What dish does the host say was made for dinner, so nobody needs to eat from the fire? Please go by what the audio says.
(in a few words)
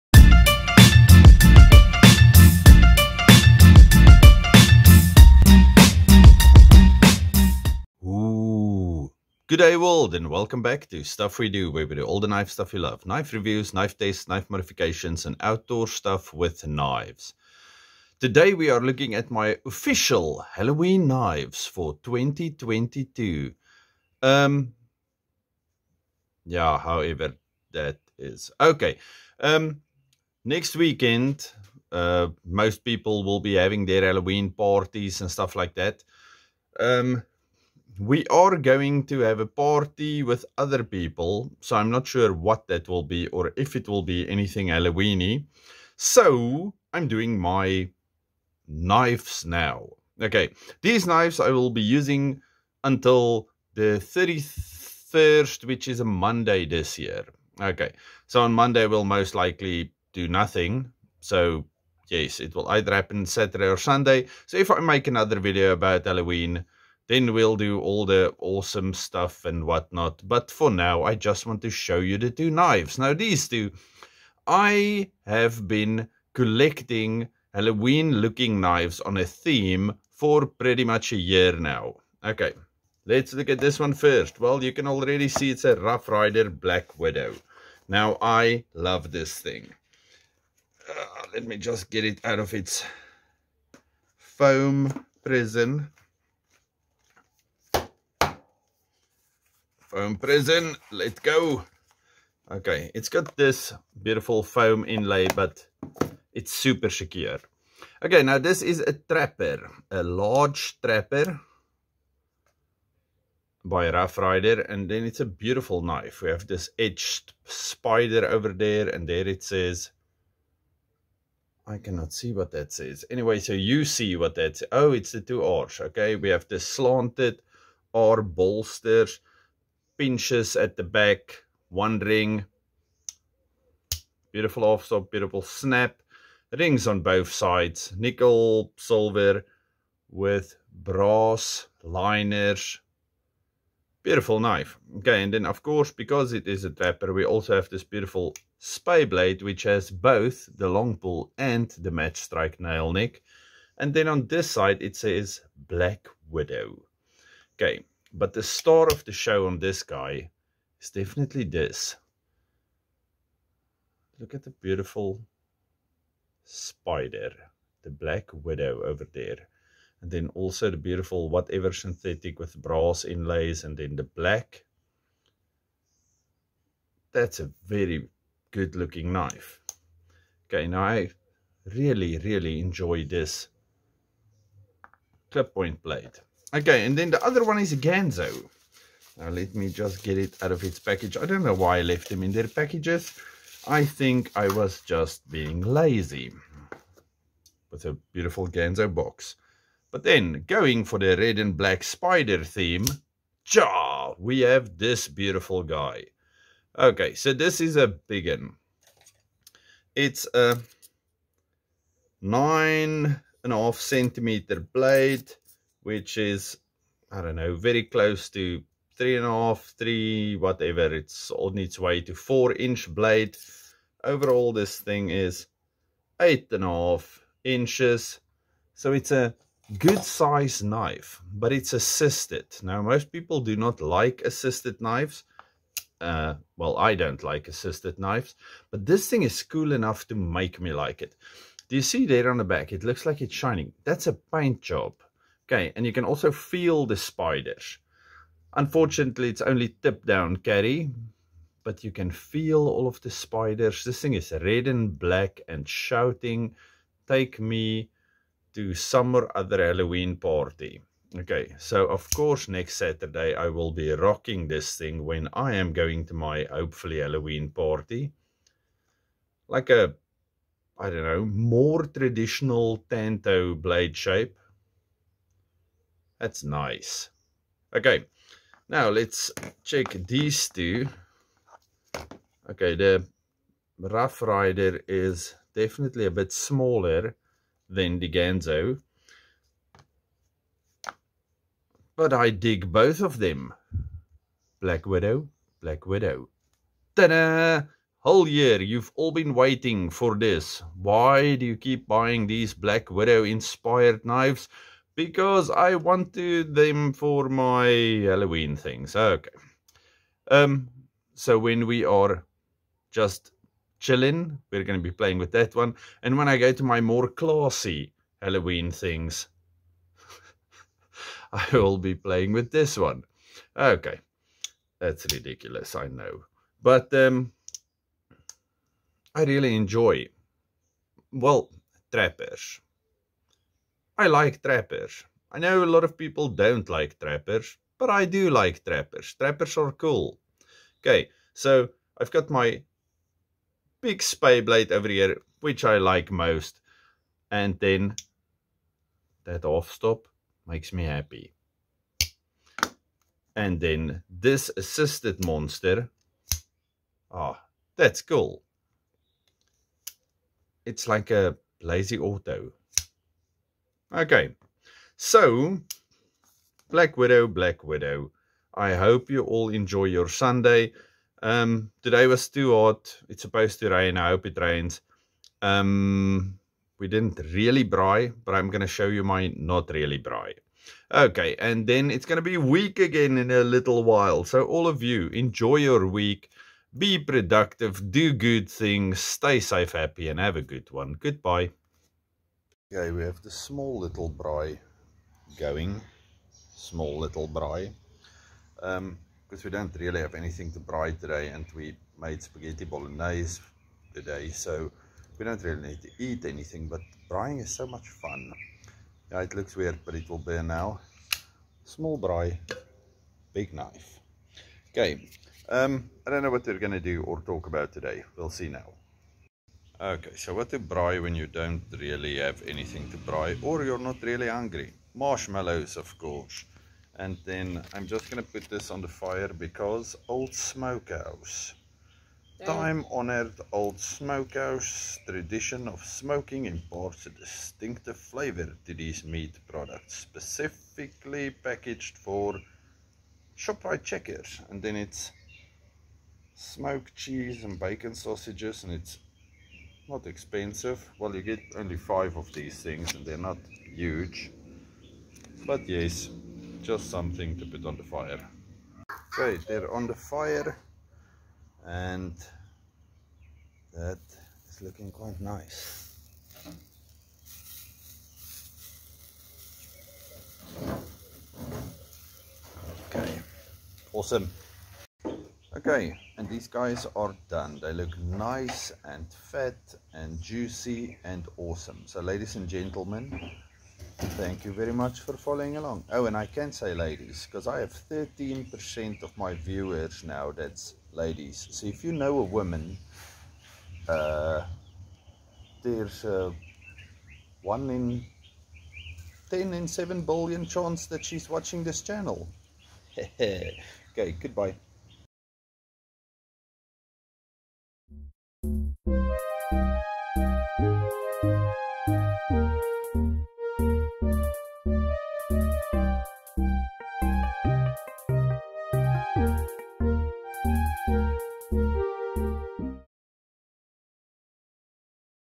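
spaghetti bolognese.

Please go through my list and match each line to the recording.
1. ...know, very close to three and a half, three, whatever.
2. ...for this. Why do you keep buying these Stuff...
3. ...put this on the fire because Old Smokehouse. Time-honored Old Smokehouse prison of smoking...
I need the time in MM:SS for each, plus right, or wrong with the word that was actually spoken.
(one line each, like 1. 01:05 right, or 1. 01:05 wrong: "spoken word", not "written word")
1. 03:37 right
2. 04:59 wrong: "Black", not "Stuff"
3. 07:08 wrong: "tradition", not "prison".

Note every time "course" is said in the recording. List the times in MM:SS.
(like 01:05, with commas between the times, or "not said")
02:25, 04:22, 07:05.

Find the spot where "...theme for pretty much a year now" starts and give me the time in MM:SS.
01:19.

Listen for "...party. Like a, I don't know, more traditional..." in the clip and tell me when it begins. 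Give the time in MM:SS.
04:27.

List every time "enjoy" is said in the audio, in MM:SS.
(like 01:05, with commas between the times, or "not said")
03:02, 05:29, 06:09, 06:25.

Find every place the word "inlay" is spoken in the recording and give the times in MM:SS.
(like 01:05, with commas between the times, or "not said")
01:44, 02:53.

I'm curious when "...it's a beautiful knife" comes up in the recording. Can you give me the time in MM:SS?
01:55.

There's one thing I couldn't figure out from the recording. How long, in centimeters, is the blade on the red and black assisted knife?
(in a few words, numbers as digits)
9.5 centimeters.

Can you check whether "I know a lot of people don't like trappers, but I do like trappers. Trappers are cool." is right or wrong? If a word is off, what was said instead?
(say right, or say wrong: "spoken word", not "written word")
right.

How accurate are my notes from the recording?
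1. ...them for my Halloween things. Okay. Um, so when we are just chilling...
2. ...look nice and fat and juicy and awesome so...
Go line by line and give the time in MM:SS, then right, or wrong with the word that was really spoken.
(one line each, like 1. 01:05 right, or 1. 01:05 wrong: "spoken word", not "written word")
1. 05:06 right
2. 07:57 right.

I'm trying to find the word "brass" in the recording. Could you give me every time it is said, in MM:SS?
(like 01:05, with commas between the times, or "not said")
02:20, 02:52.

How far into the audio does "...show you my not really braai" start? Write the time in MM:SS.
06:18.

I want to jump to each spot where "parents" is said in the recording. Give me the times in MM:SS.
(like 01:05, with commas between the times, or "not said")
not said.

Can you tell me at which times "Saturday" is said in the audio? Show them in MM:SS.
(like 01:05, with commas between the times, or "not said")
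01:03, 04:22.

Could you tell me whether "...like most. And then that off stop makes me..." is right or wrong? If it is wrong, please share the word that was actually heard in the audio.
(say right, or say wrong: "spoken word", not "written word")
right.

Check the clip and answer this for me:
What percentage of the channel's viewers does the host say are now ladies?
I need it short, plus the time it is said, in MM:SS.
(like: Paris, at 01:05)
13 percent, at 08:07.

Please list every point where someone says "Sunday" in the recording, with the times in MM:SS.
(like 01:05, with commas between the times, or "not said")
01:03, 06:10.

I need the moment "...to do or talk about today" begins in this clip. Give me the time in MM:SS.
06:56.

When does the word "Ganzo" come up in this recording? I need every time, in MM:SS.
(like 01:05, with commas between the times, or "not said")
03:07, 03:18, 04:48.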